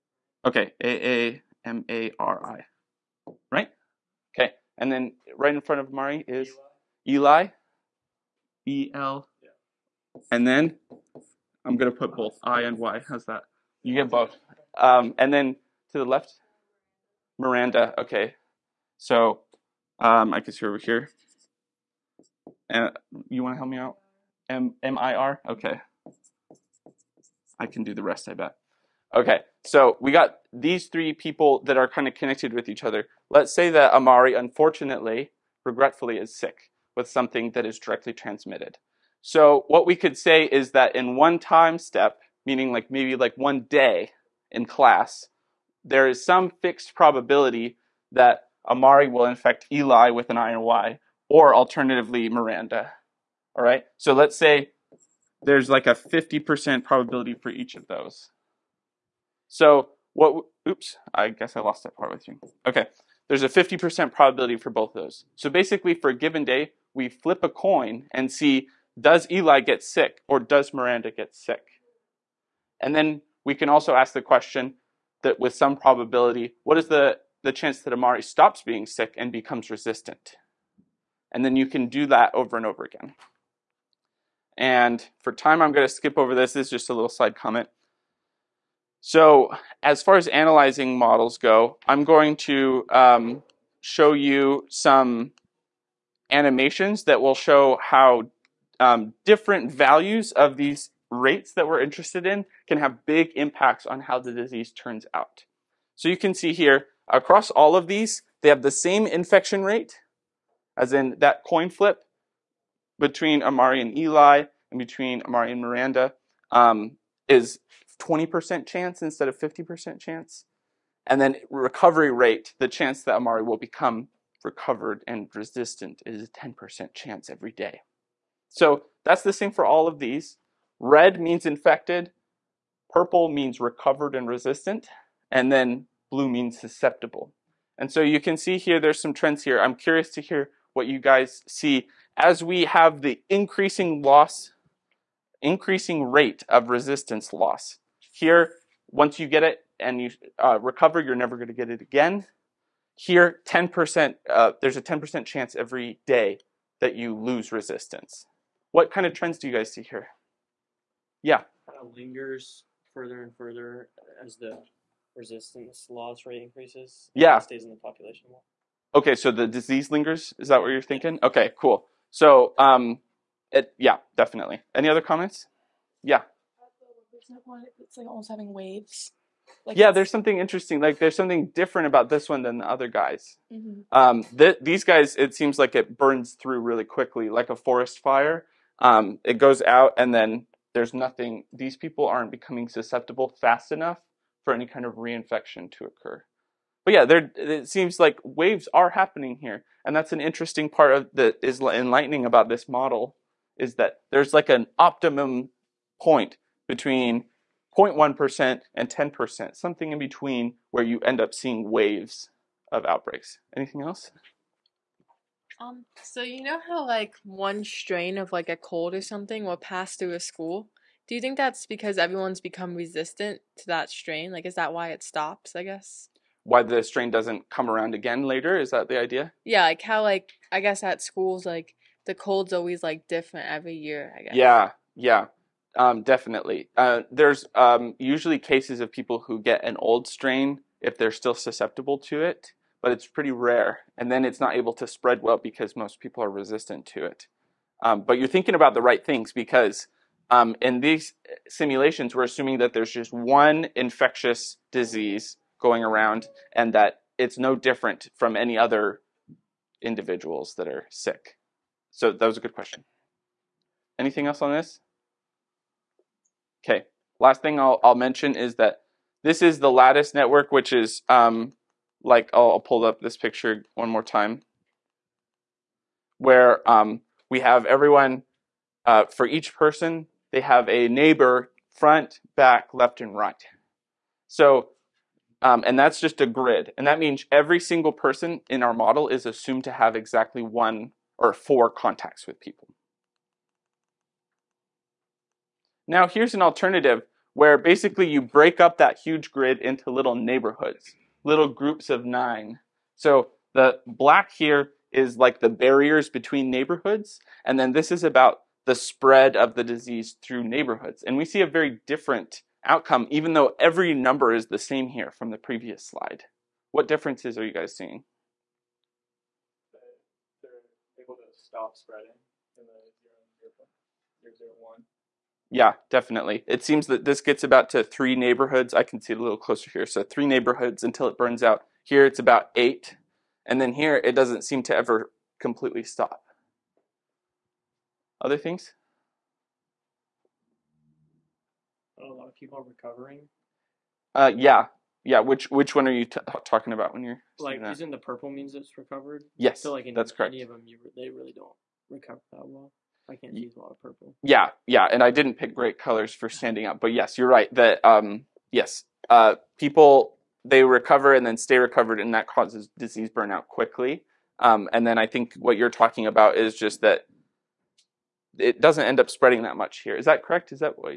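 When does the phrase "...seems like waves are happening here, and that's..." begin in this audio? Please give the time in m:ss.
3:17.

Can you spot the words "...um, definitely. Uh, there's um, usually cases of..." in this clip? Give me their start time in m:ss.
3:55.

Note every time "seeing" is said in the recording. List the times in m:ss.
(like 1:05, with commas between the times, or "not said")
3:31, 5:17.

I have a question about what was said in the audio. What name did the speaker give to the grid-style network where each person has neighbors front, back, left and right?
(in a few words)
Lattice network.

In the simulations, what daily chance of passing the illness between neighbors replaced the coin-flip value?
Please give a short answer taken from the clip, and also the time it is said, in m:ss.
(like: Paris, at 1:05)
20%, at 1:57.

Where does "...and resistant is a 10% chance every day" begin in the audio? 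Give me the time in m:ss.
2:05.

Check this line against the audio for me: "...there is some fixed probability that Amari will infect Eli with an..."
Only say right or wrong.
right.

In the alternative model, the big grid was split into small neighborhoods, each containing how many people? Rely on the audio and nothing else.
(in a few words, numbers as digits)
9.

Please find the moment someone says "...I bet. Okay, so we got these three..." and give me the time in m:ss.
0:28.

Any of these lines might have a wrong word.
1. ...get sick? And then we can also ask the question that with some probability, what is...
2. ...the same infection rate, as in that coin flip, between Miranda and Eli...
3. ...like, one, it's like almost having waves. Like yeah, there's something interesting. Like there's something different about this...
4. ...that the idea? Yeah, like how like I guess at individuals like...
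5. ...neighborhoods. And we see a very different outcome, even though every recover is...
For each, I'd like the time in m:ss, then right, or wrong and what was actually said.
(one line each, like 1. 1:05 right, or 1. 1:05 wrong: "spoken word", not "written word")
1. 1:11 right
2. 1:48 wrong: "Amari", not "Miranda"
3. 2:57 right
4. 3:48 wrong: "schools", not "individuals"
5. 5:10 wrong: "number", not "recover".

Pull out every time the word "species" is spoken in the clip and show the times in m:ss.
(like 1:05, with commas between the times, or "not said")
not said.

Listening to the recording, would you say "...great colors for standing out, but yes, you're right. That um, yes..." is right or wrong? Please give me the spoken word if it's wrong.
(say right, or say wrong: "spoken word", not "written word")
right.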